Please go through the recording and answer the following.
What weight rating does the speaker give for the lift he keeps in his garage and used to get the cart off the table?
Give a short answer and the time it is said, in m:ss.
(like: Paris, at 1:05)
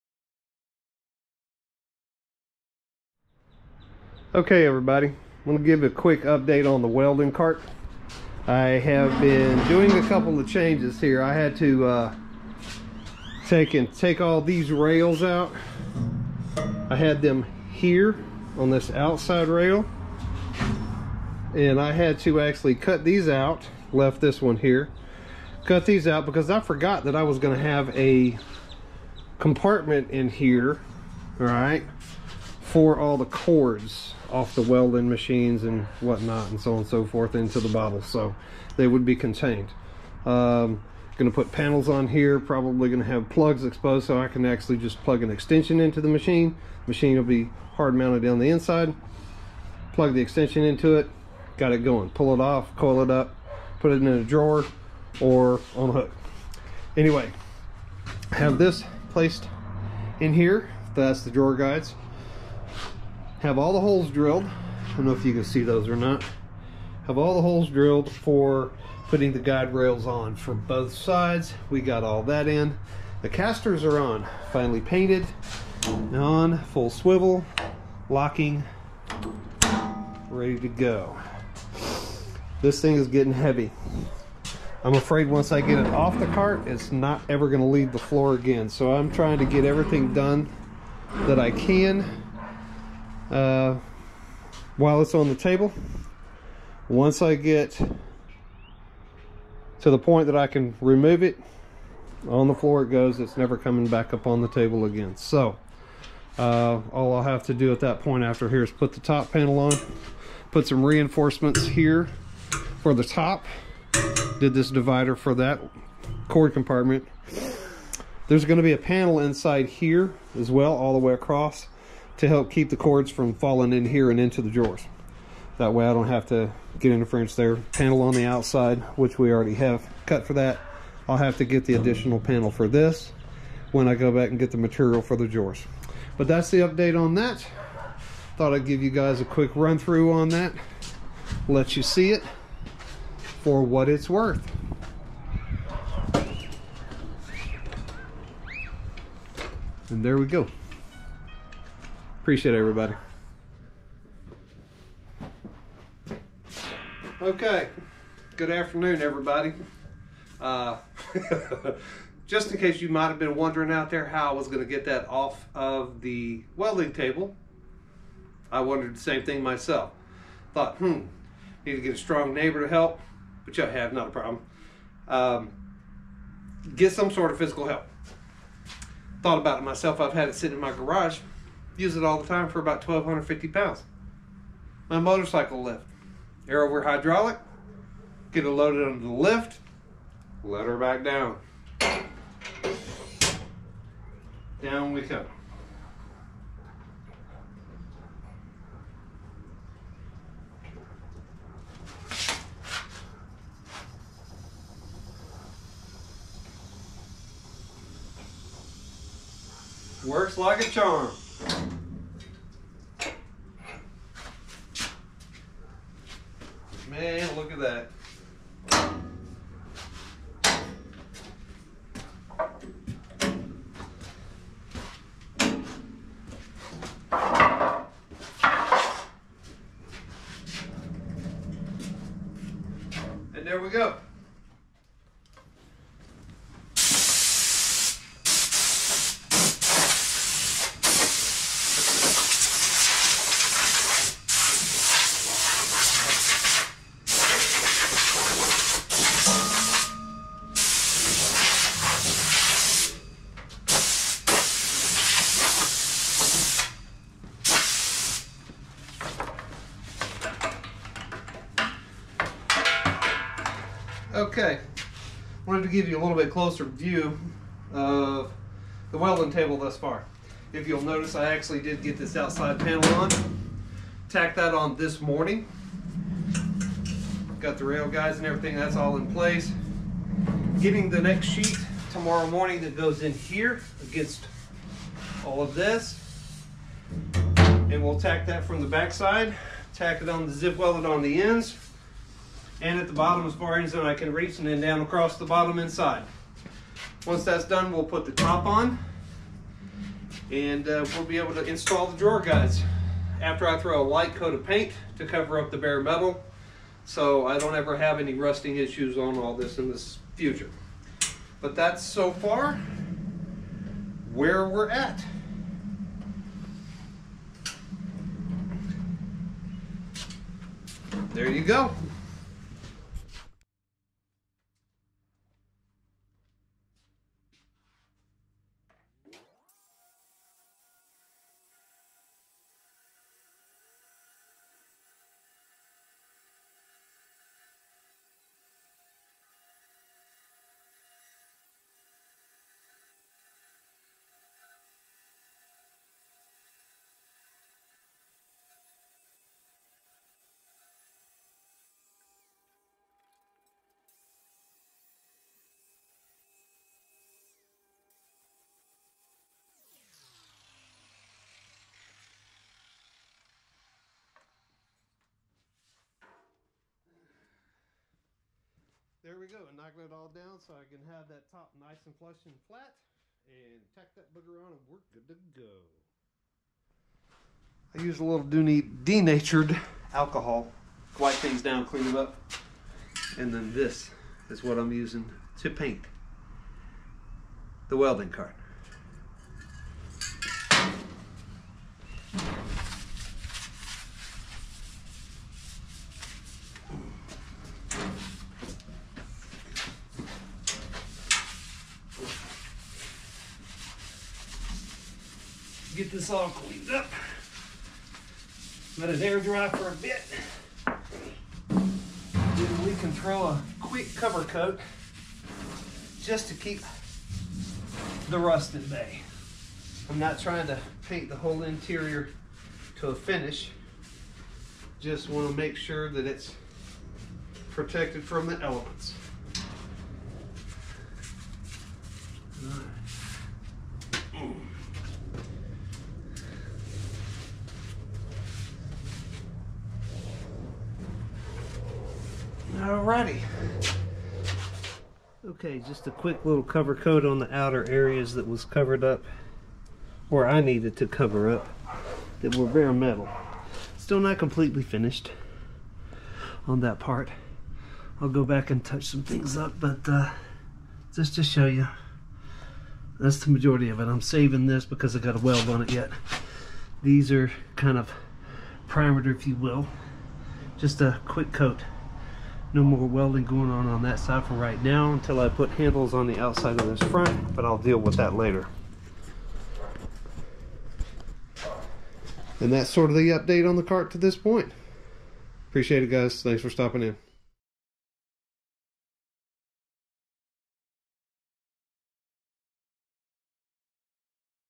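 1,250 pounds, at 3:02.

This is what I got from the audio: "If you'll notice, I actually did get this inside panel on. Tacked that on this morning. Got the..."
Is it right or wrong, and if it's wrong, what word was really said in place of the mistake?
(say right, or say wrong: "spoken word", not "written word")
wrong: "outside", not "inside".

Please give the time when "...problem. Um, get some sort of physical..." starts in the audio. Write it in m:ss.
2:54.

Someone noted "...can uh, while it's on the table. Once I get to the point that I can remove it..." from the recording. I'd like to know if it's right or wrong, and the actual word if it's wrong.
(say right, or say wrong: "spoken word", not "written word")
right.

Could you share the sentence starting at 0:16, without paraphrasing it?
I had them here on this outside rail.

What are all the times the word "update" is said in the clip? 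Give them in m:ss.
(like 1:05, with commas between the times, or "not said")
0:06, 2:16, 8:03.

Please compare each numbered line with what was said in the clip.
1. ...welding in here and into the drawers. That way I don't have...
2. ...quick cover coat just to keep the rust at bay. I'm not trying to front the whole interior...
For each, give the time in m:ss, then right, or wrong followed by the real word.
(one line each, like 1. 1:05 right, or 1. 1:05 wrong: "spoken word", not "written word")
1. 2:03 wrong: "falling", not "welding"
2. 6:53 wrong: "paint", not "front".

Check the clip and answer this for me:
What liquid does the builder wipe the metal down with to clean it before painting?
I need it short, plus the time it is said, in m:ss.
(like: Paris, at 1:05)
Denatured alcohol, at 6:18.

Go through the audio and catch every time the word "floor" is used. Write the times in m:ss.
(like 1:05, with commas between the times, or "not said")
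1:27, 1:42.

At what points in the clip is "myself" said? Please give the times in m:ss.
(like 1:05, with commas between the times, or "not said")
2:49, 2:59.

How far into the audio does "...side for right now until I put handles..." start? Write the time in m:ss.
7:53.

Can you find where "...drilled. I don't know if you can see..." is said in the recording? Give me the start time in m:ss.
1:04.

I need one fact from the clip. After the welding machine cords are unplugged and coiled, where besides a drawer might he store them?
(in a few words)
On a hook.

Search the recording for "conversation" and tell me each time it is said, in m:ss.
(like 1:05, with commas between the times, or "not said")
not said.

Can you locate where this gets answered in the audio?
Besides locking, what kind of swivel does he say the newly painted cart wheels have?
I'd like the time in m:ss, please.
1:16.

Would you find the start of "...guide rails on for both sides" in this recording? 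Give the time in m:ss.
1:09.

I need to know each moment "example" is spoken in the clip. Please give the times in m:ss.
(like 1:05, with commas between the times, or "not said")
not said.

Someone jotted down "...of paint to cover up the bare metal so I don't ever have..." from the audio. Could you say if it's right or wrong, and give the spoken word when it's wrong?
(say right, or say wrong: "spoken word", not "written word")
right.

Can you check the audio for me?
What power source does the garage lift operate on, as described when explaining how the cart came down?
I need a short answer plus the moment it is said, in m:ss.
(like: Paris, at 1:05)
Air over hydraulic, at 3:06.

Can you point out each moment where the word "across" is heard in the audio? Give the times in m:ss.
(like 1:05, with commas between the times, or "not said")
2:01, 4:54.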